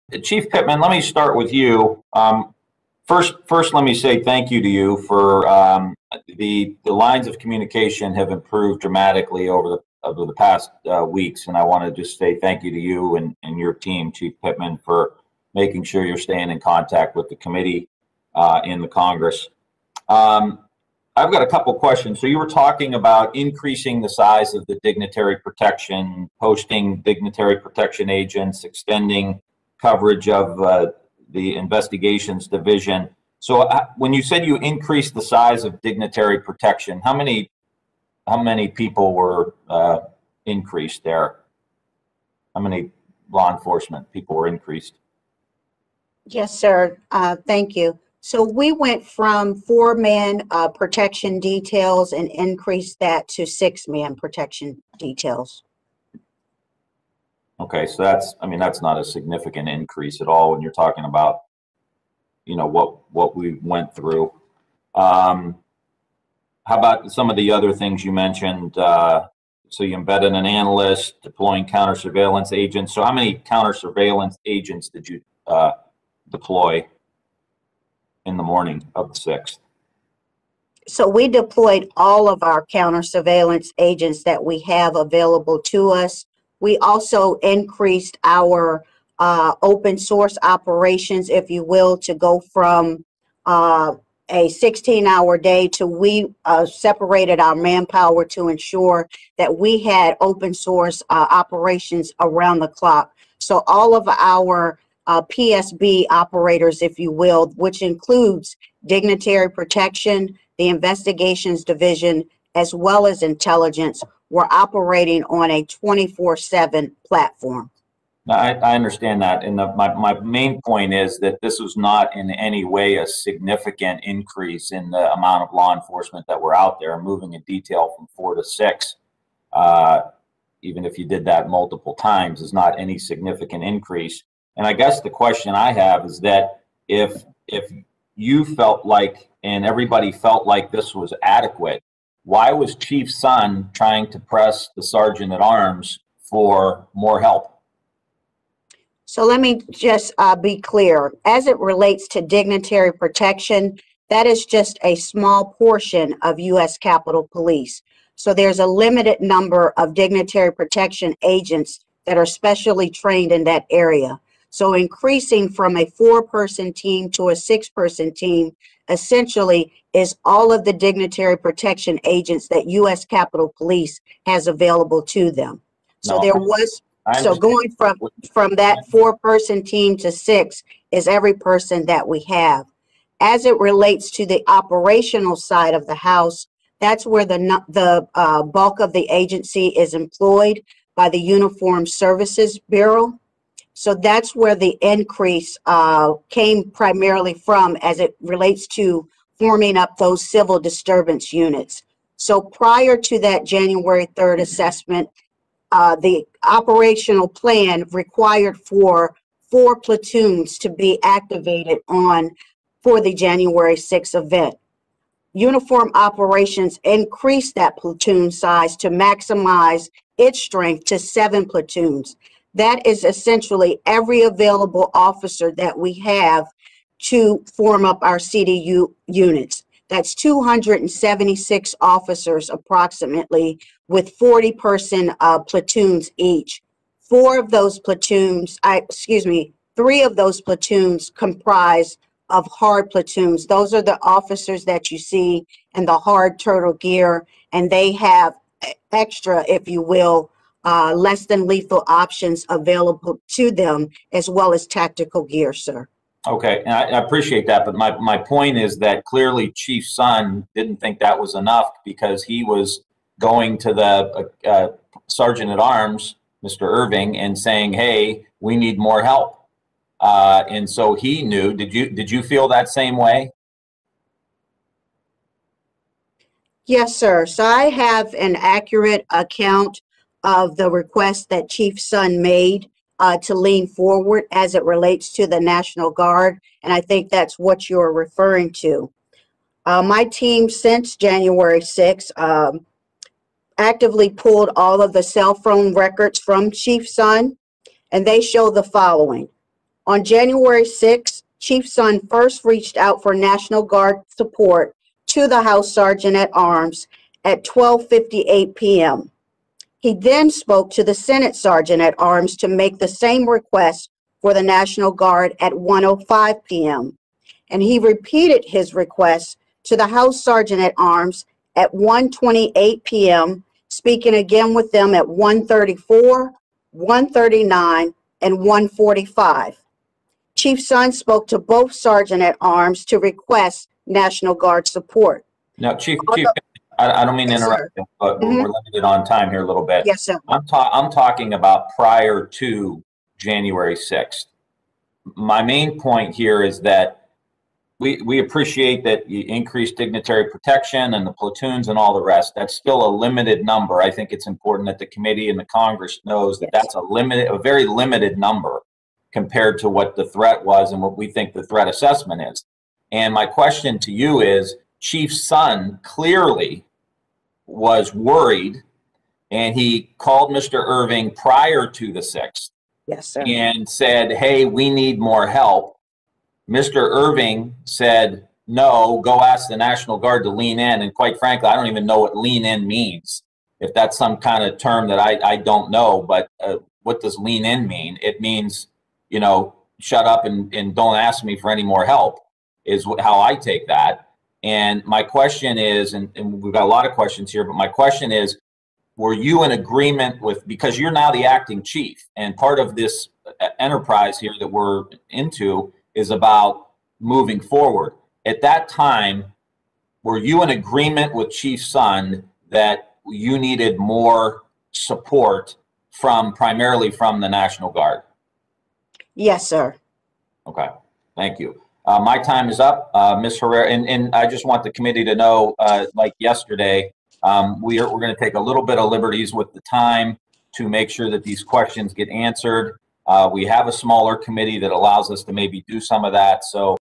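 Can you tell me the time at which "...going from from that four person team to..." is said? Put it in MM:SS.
02:57.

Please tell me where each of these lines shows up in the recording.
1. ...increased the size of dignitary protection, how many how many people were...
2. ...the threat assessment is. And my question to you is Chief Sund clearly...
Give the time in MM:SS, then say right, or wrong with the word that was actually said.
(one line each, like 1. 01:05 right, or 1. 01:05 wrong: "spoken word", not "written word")
1. 00:34 right
2. 06:01 right.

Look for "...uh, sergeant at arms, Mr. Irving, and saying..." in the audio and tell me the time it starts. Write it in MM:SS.
04:24.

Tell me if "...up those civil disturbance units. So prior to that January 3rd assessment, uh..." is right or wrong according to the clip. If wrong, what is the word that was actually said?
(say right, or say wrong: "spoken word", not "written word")
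right.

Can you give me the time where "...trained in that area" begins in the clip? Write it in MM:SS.
02:42.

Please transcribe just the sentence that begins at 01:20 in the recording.
So we deployed all of our counter surveillance agents that we have available to us.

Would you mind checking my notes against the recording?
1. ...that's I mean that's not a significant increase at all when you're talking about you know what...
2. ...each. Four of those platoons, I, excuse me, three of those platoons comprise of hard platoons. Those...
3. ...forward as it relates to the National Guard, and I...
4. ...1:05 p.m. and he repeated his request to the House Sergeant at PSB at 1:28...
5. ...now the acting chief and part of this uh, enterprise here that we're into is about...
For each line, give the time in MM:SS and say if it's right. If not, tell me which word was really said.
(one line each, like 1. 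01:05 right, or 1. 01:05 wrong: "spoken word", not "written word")
1. 00:58 right
2. 03:56 right
3. 04:43 right
4. 05:15 wrong: "Arms", not "PSB"
5. 06:40 right.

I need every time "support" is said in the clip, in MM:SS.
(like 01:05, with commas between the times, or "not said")
05:04, 05:34, 06:54.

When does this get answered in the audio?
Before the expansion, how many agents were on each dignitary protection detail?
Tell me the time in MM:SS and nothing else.
00:49.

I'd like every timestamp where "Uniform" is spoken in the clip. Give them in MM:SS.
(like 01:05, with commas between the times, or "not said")
03:11, 03:35.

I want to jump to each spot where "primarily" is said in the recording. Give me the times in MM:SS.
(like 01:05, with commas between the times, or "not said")
03:16, 06:56.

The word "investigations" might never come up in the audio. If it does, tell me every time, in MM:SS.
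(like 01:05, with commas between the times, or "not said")
00:31, 01:50.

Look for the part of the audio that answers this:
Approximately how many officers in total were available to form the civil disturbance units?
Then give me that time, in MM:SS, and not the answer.
03:50.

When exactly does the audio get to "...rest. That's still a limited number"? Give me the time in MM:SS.
05:52.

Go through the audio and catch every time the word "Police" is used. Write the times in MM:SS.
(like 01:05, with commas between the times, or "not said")
02:37, 02:53.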